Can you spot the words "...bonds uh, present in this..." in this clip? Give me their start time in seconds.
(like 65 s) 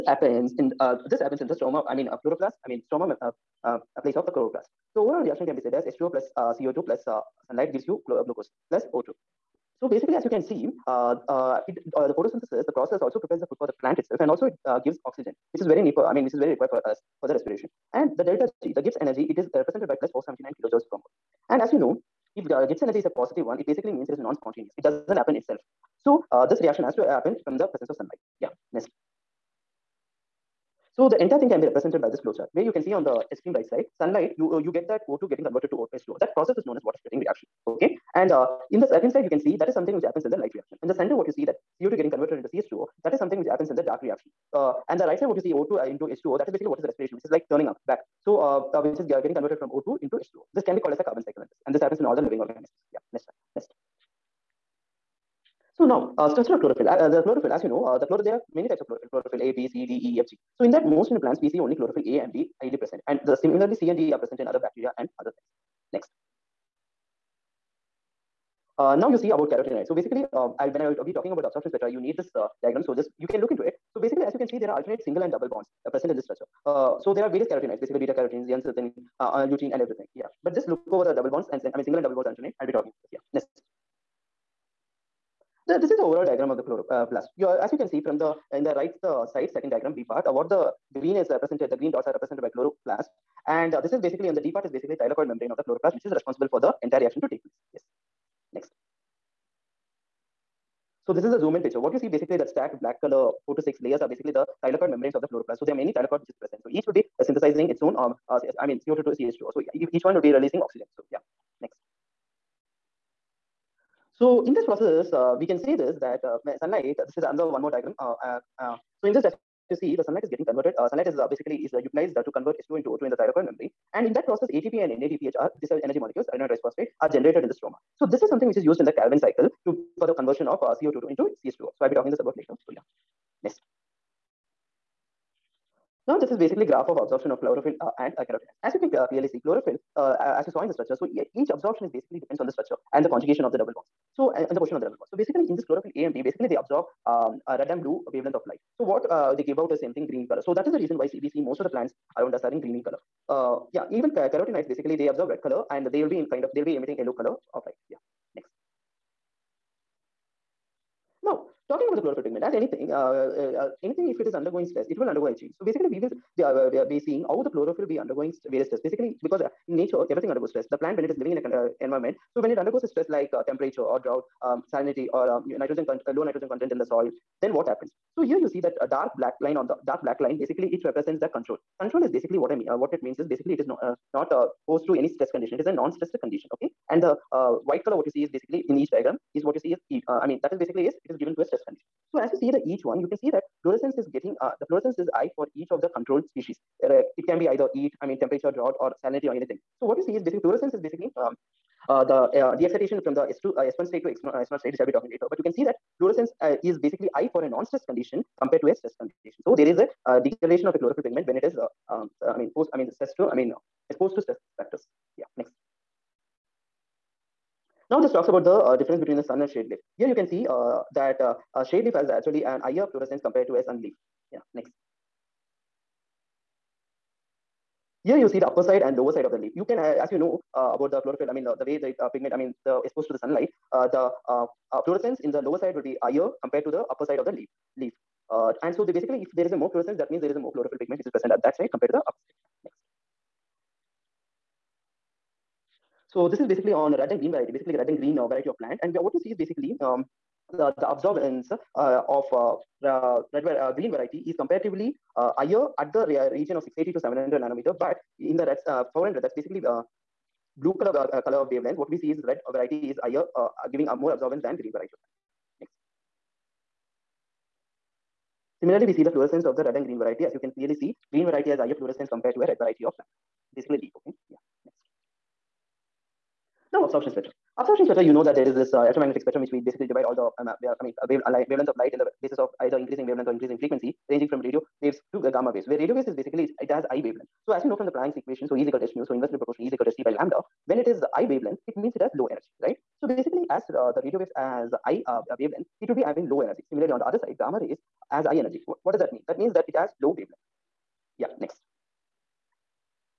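75 s.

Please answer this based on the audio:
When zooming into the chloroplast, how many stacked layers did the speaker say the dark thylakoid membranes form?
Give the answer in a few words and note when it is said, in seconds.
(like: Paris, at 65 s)
4 to 6, at 103 s.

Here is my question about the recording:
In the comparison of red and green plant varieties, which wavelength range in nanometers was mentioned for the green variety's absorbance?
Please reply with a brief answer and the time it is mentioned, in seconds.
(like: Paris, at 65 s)
680 to 700 nm, at 256 s.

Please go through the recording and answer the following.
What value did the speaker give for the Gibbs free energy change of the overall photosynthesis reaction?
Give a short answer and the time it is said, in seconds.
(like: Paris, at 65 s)
+479 kJ/mol, at 20 s.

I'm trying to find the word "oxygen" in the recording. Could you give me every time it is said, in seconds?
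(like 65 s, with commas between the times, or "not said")
15 s, 110 s.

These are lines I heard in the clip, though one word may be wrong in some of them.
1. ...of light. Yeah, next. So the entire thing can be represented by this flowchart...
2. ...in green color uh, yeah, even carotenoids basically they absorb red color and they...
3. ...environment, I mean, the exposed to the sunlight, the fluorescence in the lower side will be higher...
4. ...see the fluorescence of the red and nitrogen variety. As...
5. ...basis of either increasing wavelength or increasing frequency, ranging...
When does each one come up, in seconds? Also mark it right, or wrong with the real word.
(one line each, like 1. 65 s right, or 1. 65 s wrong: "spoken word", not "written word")
1. 27 s wrong: "sunlight", not "light"
2. 152 s right
3. 232 s wrong: "pigment", not "environment"
4. 268 s wrong: "green", not "nitrogen"
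5. 282 s right.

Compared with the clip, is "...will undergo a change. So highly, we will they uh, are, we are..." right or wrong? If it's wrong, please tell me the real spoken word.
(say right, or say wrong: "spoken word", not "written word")
wrong: "basically", not "highly".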